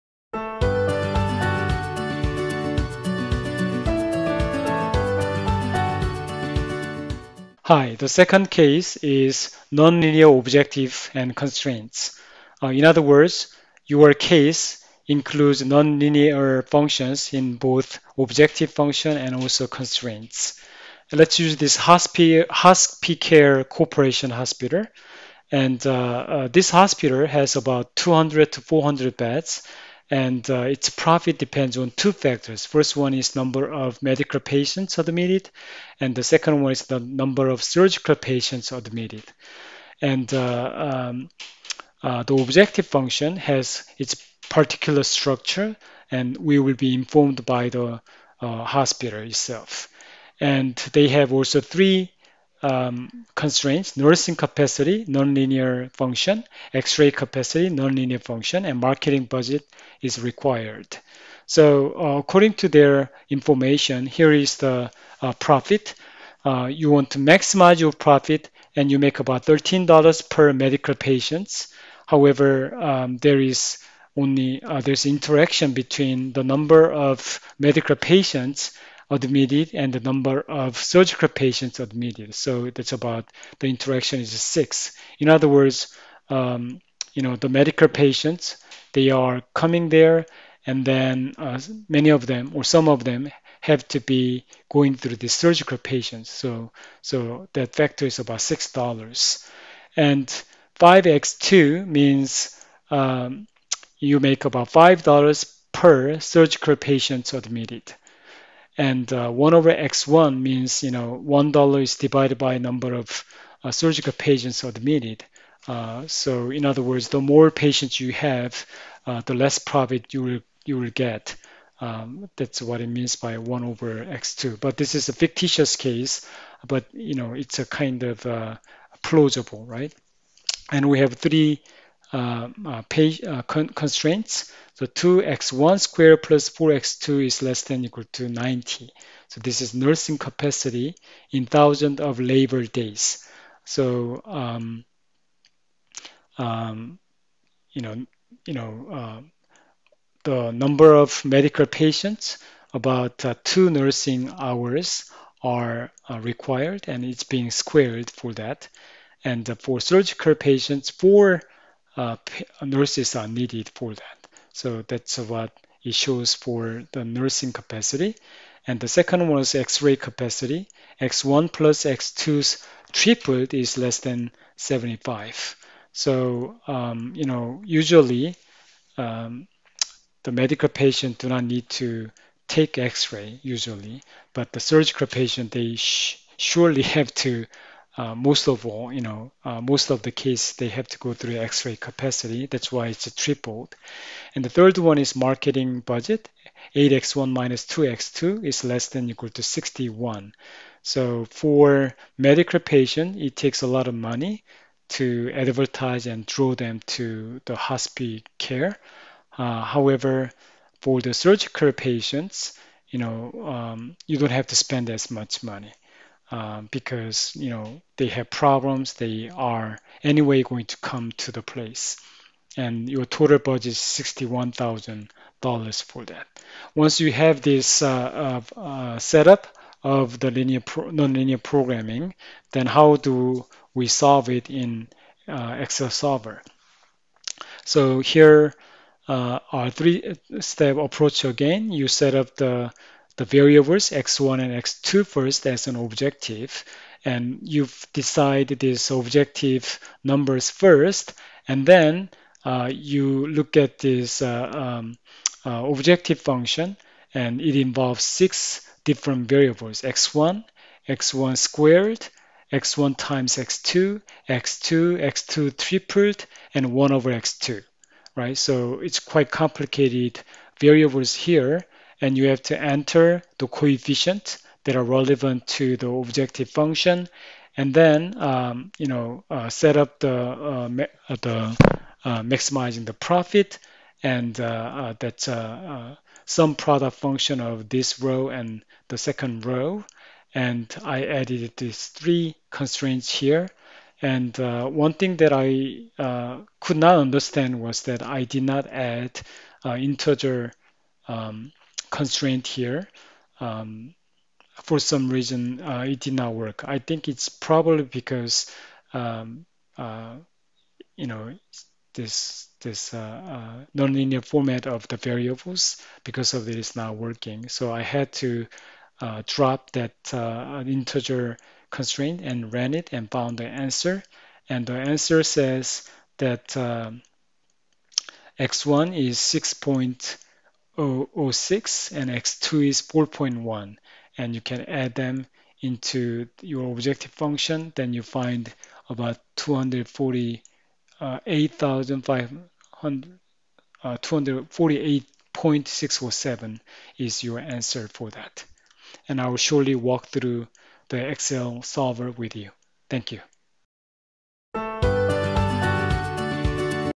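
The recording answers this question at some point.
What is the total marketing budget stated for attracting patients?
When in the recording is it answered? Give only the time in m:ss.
3:43.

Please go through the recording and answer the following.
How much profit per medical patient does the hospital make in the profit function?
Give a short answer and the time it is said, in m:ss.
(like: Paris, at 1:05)
$13, at 1:09.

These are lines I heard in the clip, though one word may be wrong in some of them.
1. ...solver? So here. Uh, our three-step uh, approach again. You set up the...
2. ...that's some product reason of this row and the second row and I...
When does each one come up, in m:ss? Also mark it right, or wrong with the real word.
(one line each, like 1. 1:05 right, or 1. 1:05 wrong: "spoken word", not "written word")
1. 3:55 right
2. 4:44 wrong: "function", not "reason".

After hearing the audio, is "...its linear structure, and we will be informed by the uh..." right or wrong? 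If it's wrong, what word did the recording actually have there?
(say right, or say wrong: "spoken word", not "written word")
wrong: "particular", not "linear".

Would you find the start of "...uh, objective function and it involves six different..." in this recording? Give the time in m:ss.
4:15.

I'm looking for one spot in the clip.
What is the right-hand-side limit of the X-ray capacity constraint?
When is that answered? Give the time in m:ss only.
2:54.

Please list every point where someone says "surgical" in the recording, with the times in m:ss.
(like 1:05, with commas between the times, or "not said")
0:37, 1:20, 1:35, 1:46, 1:53, 2:39, 3:04, 3:31.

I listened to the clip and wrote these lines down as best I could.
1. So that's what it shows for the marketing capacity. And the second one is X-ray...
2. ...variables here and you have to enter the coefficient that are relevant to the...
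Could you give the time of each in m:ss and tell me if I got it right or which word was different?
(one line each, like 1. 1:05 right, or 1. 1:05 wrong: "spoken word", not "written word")
1. 2:44 wrong: "nursing", not "marketing"
2. 4:30 right.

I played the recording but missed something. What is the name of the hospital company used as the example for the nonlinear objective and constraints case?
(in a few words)
HospiCare Corporation.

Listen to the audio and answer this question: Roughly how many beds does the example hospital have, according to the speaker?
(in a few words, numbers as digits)
200 to 400.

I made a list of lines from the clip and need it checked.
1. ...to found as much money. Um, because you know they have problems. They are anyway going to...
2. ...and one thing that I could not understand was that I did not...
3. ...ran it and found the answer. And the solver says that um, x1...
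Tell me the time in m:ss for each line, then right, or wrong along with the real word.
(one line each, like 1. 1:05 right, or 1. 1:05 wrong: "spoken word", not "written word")
1. 3:34 wrong: "spend", not "found"
2. 4:54 right
3. 5:22 wrong: "answer", not "solver".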